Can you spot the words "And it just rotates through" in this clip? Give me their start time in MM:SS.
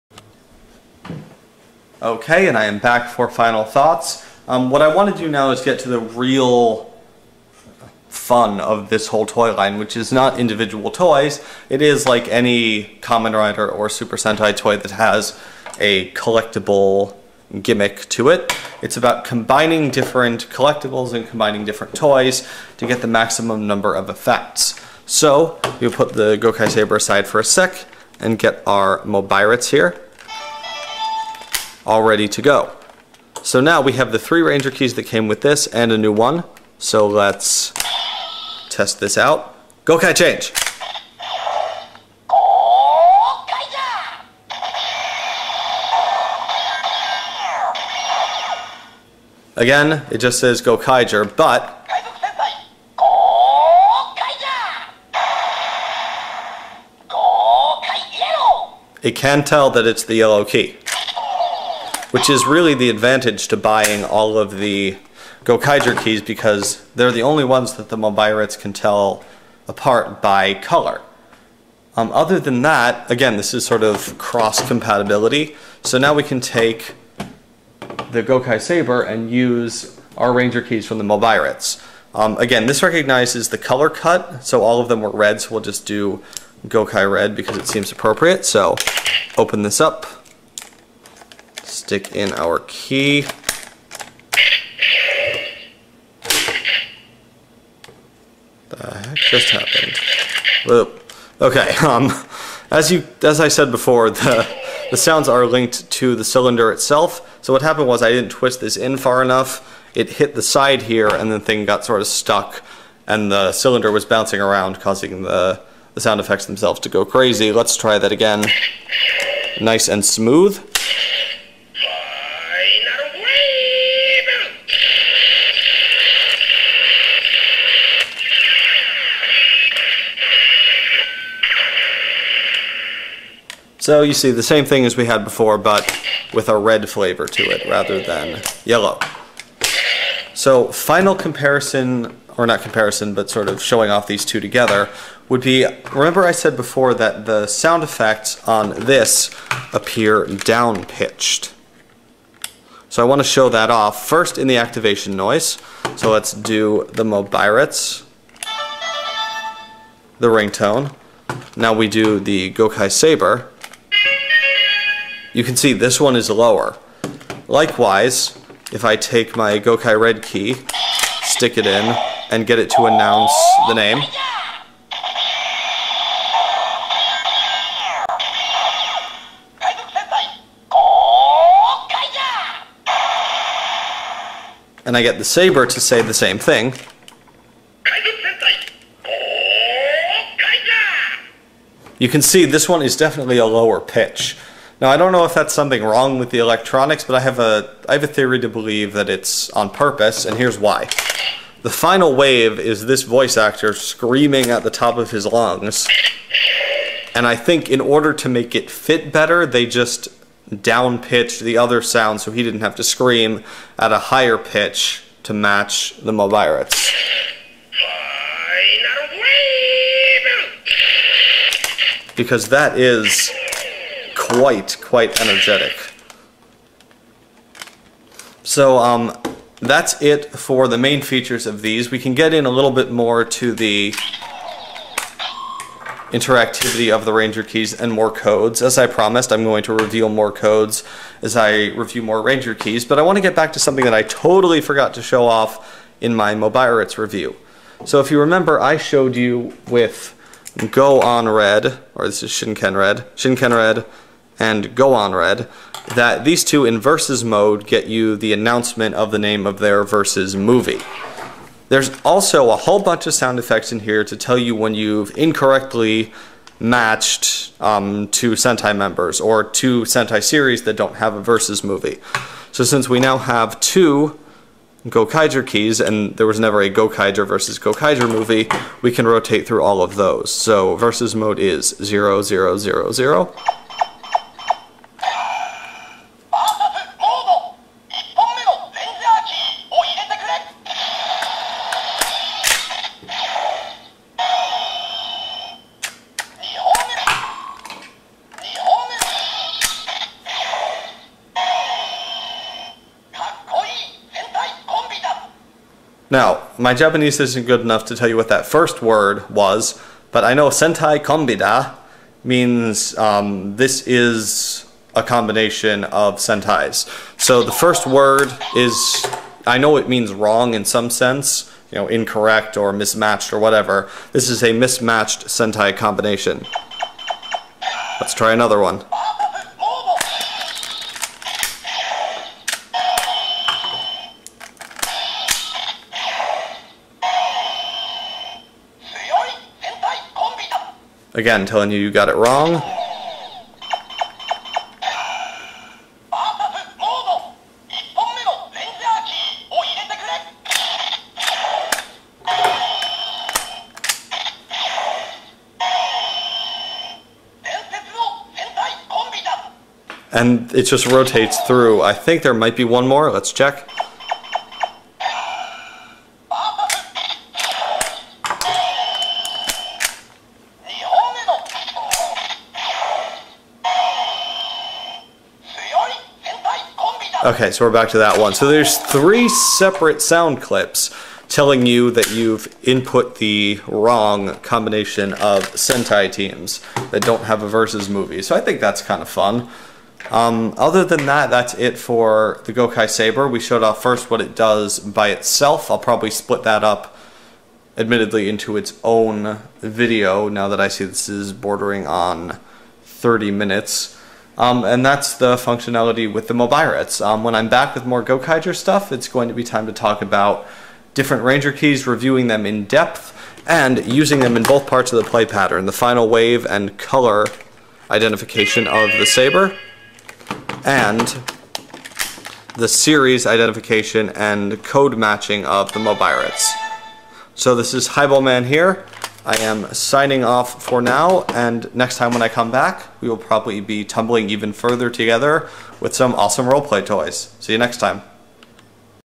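06:00.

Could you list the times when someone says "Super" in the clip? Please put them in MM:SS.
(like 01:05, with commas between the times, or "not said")
00:13.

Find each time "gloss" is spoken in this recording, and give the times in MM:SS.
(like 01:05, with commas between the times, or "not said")
not said.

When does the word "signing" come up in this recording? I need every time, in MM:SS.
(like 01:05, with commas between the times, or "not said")
07:09.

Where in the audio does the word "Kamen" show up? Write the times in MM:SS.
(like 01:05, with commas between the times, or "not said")
00:13.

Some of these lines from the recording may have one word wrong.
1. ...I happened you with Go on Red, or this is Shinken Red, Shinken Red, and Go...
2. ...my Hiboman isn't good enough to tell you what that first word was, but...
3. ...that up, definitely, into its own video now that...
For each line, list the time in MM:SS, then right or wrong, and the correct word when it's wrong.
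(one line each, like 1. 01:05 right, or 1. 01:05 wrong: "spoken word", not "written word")
1. 04:08 wrong: "showed", not "happened"
2. 05:06 wrong: "Japanese", not "Hiboman"
3. 06:36 wrong: "admittedly", not "definitely".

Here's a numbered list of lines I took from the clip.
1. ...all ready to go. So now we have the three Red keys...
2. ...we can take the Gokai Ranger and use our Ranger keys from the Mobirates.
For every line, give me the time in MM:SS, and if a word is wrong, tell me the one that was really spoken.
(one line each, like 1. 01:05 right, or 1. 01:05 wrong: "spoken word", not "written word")
1. 00:31 wrong: "Ranger", not "Red"
2. 01:16 wrong: "Saber", not "Ranger".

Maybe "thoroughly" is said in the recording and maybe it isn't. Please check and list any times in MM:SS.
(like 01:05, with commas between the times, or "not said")
not said.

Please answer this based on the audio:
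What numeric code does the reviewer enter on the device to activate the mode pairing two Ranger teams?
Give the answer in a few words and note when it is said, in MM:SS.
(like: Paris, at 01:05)
0000, at 04:41.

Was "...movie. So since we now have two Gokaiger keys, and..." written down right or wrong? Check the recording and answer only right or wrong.
right.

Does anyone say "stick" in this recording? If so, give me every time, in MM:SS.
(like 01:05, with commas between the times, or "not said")
01:31, 02:51.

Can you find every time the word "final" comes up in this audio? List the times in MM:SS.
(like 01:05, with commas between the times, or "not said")
00:03, 02:20, 03:21, 06:55.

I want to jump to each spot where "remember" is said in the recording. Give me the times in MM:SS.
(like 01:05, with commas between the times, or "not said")
02:25, 04:08.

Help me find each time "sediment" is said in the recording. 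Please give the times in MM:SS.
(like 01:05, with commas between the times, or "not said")
not said.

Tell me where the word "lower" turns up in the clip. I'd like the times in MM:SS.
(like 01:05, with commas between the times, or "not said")
02:46, 03:13.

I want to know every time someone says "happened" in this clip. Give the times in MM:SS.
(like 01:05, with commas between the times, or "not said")
01:39, 01:47.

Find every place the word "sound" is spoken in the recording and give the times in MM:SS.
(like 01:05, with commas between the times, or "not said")
01:44, 01:55, 02:27, 03:31, 04:23, 06:20.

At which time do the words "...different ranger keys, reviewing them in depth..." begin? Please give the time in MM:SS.
06:50.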